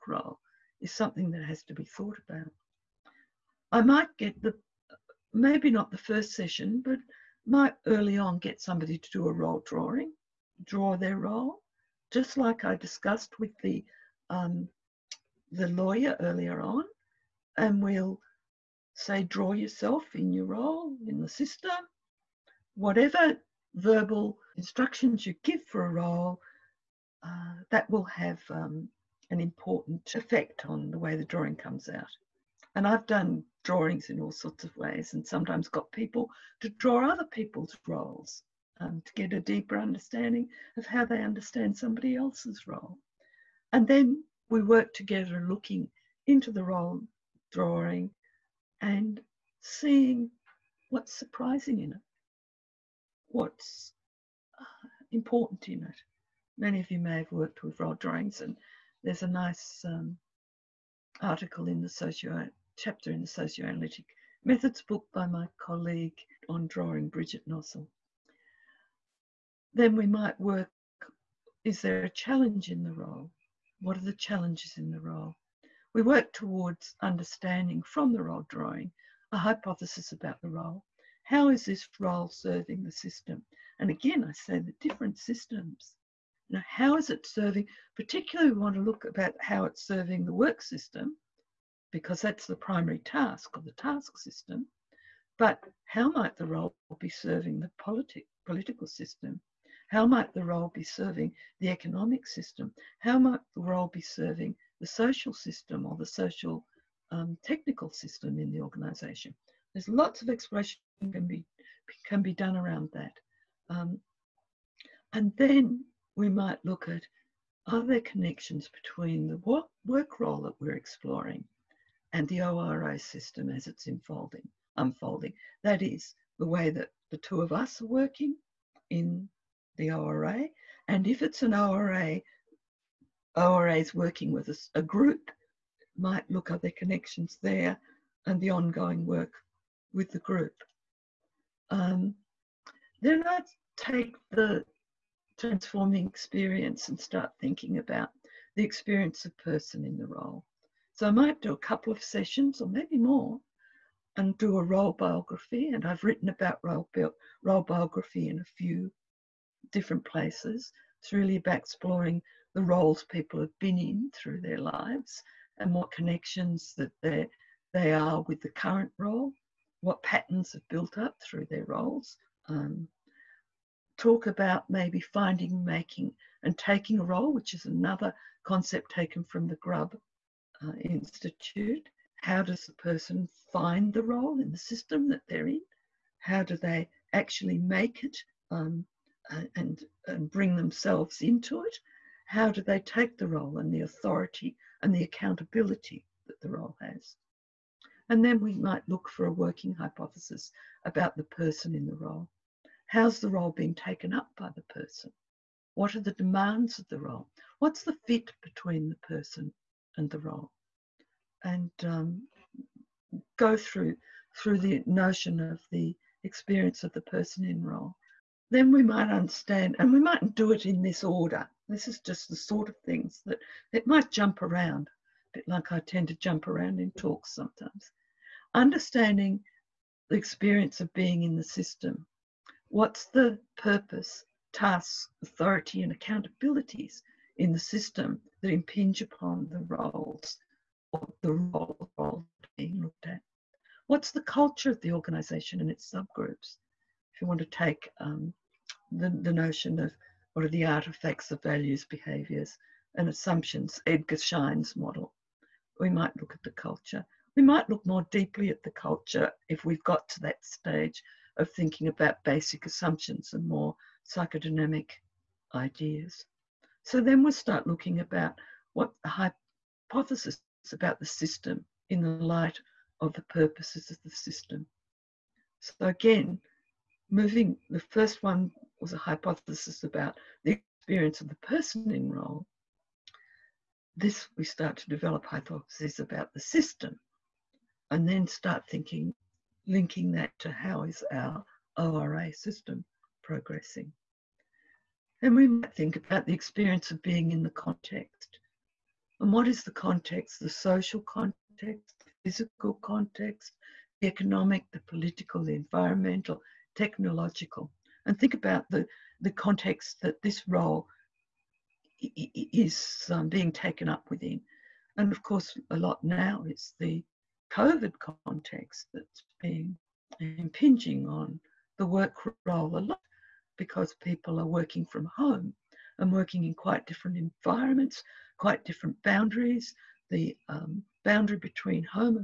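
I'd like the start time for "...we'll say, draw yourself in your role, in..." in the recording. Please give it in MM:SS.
00:17.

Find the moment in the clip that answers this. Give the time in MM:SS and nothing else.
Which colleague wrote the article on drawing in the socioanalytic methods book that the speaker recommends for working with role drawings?
01:07.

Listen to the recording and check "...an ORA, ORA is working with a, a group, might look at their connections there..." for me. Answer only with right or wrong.
right.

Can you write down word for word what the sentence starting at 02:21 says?
Um, then I take the transforming experience and start thinking about the experience of person in the role.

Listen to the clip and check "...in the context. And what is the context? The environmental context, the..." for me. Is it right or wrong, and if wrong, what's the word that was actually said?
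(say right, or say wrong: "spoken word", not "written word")
wrong: "social", not "environmental".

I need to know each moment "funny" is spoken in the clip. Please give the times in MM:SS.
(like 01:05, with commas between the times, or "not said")
not said.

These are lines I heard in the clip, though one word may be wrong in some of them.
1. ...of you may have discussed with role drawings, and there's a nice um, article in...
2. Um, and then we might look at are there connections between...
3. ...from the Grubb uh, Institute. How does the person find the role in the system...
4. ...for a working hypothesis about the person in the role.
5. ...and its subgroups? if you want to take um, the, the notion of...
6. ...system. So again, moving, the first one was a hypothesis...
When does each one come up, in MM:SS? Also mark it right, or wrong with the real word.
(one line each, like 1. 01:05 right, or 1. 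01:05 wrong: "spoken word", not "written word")
1. 00:56 wrong: "worked", not "discussed"
2. 01:53 right
3. 02:59 right
4. 03:19 right
5. 04:05 right
6. 04:34 right.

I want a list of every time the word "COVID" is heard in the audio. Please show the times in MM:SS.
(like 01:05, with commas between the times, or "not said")
05:17.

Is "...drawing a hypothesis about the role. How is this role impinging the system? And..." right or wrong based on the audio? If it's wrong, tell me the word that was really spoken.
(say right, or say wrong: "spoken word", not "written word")
wrong: "serving", not "impinging".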